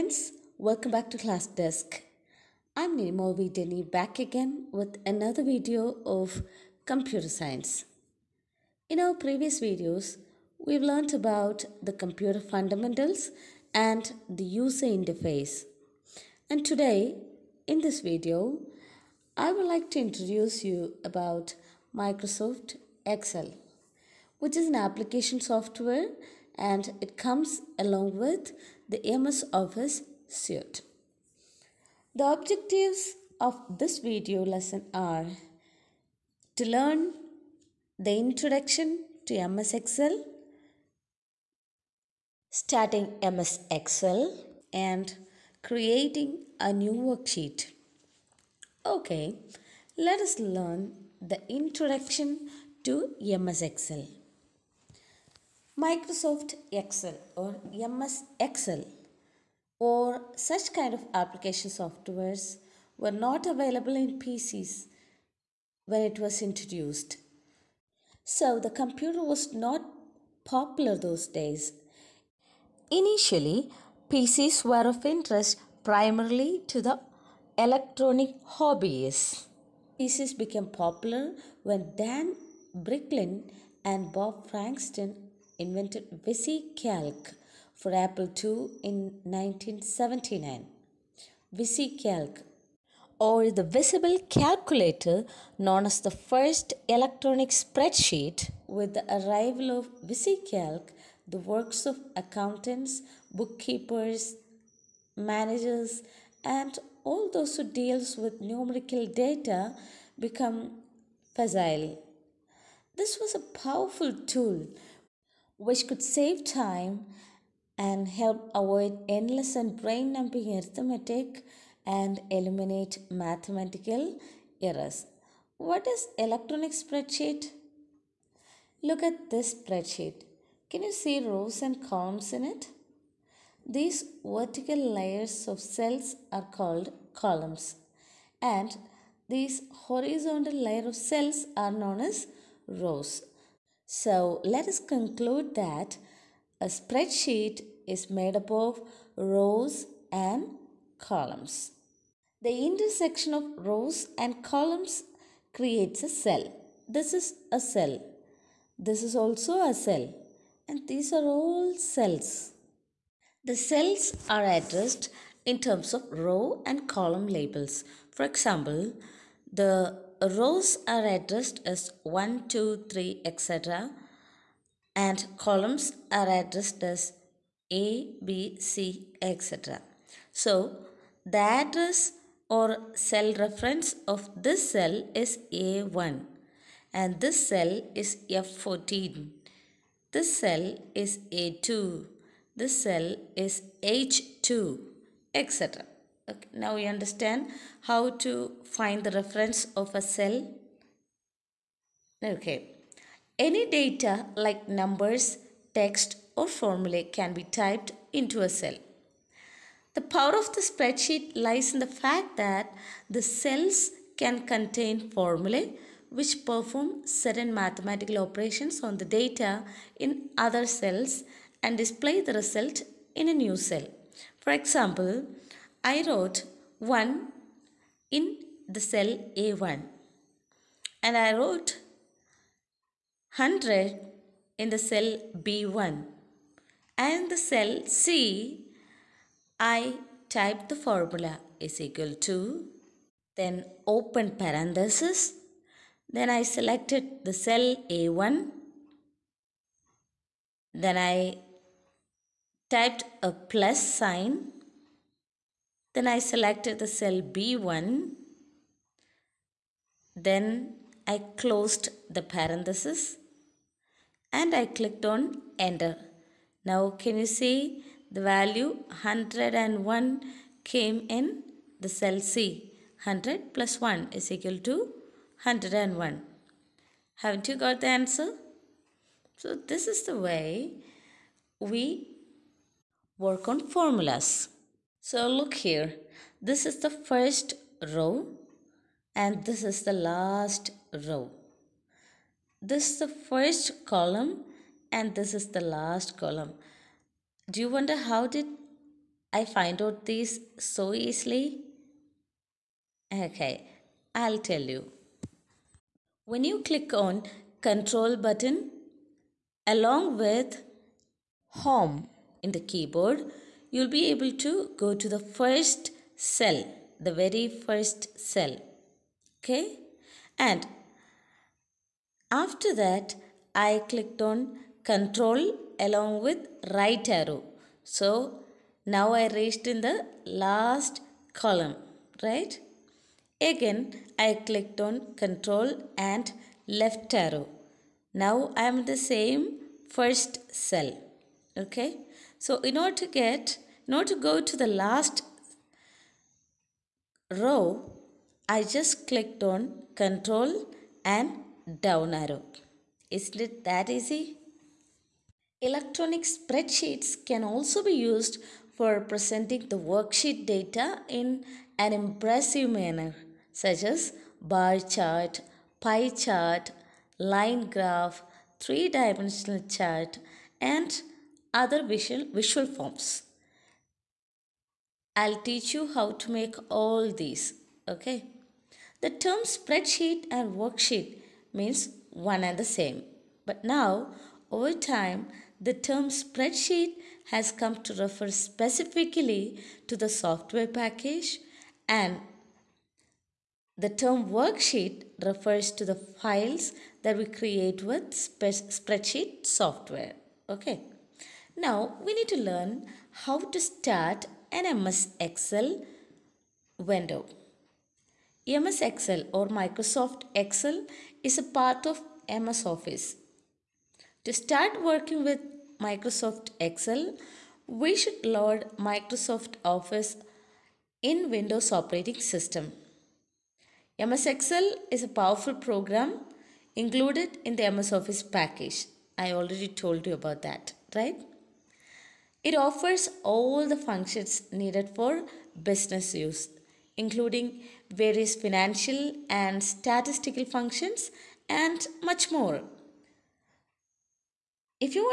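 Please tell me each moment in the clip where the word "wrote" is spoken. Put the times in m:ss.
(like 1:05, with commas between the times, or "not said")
3:46, 3:51.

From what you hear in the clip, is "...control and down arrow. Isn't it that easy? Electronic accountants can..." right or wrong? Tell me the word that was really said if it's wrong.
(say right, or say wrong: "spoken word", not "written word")
wrong: "spreadsheets", not "accountants".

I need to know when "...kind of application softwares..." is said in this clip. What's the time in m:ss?
1:00.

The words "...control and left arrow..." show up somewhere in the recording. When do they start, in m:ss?
5:35.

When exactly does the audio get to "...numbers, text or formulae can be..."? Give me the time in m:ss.
3:24.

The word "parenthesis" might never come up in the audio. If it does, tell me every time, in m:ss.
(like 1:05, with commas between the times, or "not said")
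4:04, 4:22.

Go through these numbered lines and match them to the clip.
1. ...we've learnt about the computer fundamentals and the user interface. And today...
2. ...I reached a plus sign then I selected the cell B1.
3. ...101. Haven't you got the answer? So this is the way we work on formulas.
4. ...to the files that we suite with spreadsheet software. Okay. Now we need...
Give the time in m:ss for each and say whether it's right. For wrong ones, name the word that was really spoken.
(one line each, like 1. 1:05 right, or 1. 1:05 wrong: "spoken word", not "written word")
1. 0:10 right
2. 4:10 wrong: "typed", not "reached"
3. 4:35 right
4. 6:35 wrong: "create", not "suite".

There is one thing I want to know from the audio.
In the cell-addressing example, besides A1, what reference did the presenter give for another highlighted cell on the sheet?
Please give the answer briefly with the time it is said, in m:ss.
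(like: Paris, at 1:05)
F14, at 3:08.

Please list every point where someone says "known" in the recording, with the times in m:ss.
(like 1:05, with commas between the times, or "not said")
1:35, 2:21.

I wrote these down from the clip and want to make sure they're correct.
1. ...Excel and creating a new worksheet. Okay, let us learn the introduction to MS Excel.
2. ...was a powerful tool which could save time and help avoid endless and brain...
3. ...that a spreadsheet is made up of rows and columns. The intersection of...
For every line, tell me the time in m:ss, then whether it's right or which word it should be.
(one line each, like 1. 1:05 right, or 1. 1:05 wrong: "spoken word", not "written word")
1. 0:43 right
2. 1:53 right
3. 2:25 right.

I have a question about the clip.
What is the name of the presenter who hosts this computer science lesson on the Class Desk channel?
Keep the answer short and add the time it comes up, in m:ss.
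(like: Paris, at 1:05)
Ninimol Denny, at 0:02.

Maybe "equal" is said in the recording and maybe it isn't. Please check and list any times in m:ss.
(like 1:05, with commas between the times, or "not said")
4:01, 4:34.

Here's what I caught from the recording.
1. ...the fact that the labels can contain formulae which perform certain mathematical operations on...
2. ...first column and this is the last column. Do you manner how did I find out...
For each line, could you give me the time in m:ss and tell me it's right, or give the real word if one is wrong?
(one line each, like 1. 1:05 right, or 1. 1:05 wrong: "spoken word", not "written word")
1. 3:31 wrong: "cells", not "labels"
2. 4:53 wrong: "wonder", not "manner".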